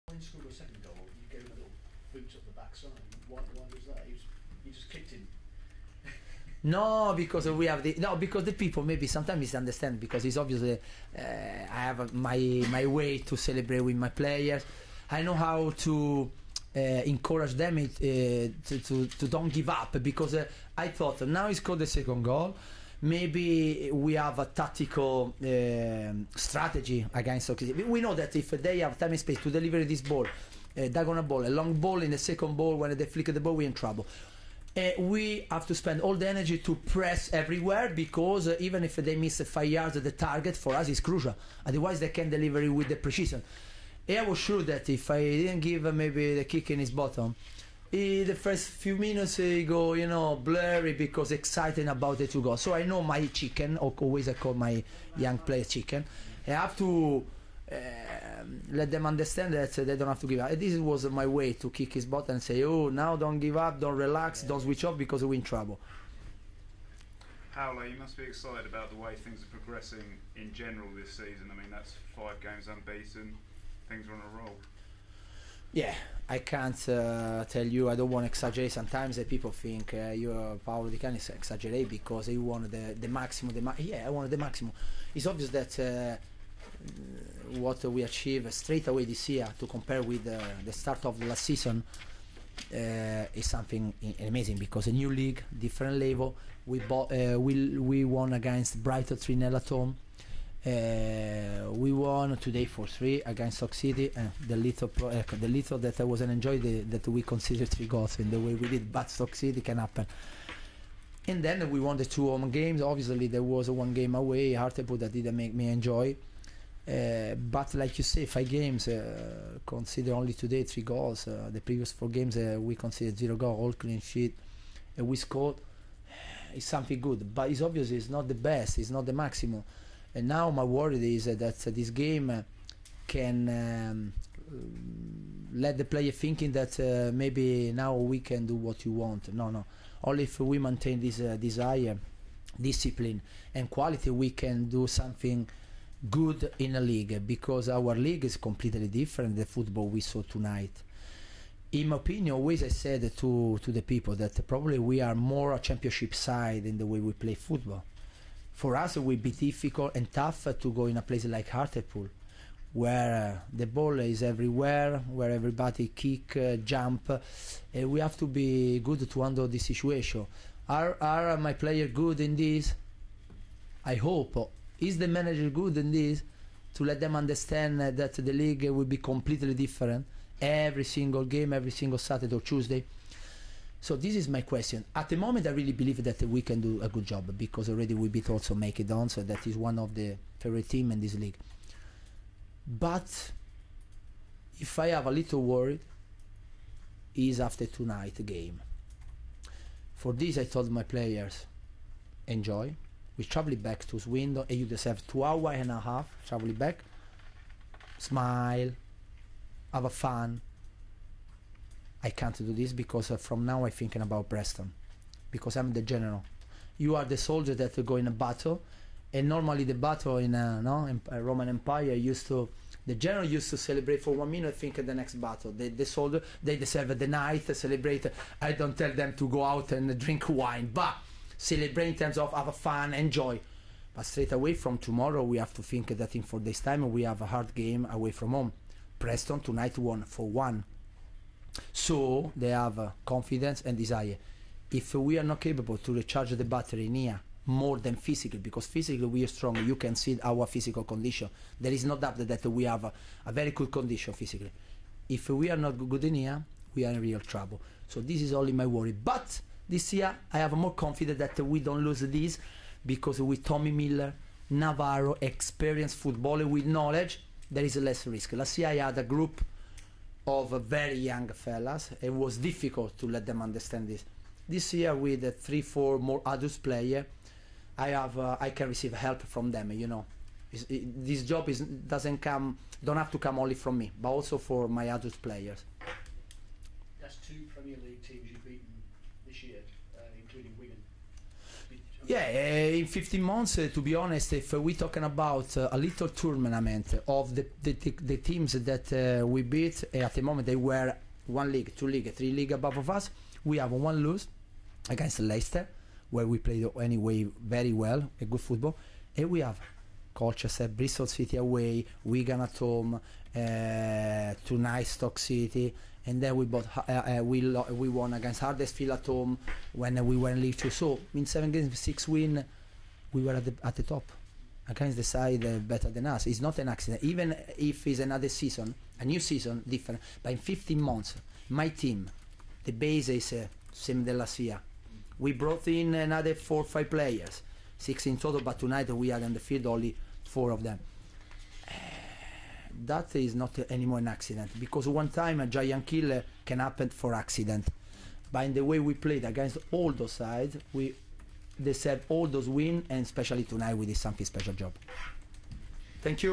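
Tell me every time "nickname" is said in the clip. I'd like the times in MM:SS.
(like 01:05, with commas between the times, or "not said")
not said.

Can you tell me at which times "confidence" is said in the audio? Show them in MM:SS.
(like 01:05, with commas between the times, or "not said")
04:03, 04:20.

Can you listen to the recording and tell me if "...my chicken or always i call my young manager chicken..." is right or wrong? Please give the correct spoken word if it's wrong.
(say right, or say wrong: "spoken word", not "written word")
wrong: "player", not "manager".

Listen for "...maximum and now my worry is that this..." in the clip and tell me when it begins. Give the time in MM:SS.
02:09.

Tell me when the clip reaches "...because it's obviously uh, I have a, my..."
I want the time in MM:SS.
00:09.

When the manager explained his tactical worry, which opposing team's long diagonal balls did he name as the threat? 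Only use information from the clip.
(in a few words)
OKC.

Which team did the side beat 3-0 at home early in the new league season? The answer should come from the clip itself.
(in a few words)
Brighton.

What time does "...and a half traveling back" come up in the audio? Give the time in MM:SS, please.
03:25.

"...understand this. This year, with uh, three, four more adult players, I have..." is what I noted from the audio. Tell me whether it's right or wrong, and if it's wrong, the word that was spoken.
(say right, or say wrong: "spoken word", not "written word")
right.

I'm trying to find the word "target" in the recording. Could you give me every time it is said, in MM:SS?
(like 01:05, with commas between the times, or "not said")
00:40.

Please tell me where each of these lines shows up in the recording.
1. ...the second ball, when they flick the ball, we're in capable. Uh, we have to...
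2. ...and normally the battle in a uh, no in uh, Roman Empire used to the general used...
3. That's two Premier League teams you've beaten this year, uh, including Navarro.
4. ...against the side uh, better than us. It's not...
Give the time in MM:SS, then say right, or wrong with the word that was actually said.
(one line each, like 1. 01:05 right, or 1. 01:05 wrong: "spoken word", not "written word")
1. 00:32 wrong: "trouble", not "capable"
2. 03:39 right
3. 04:46 wrong: "Wigan", not "Navarro"
4. 05:24 right.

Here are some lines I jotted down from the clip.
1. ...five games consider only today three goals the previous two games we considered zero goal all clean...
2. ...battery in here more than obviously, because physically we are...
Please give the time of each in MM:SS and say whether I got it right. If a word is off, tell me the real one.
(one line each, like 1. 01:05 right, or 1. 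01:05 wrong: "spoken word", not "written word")
1. 01:58 wrong: "four", not "two"
2. 04:06 wrong: "physically", not "obviously".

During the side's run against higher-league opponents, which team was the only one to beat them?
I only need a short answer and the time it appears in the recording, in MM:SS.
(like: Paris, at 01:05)
Leicester, at 05:05.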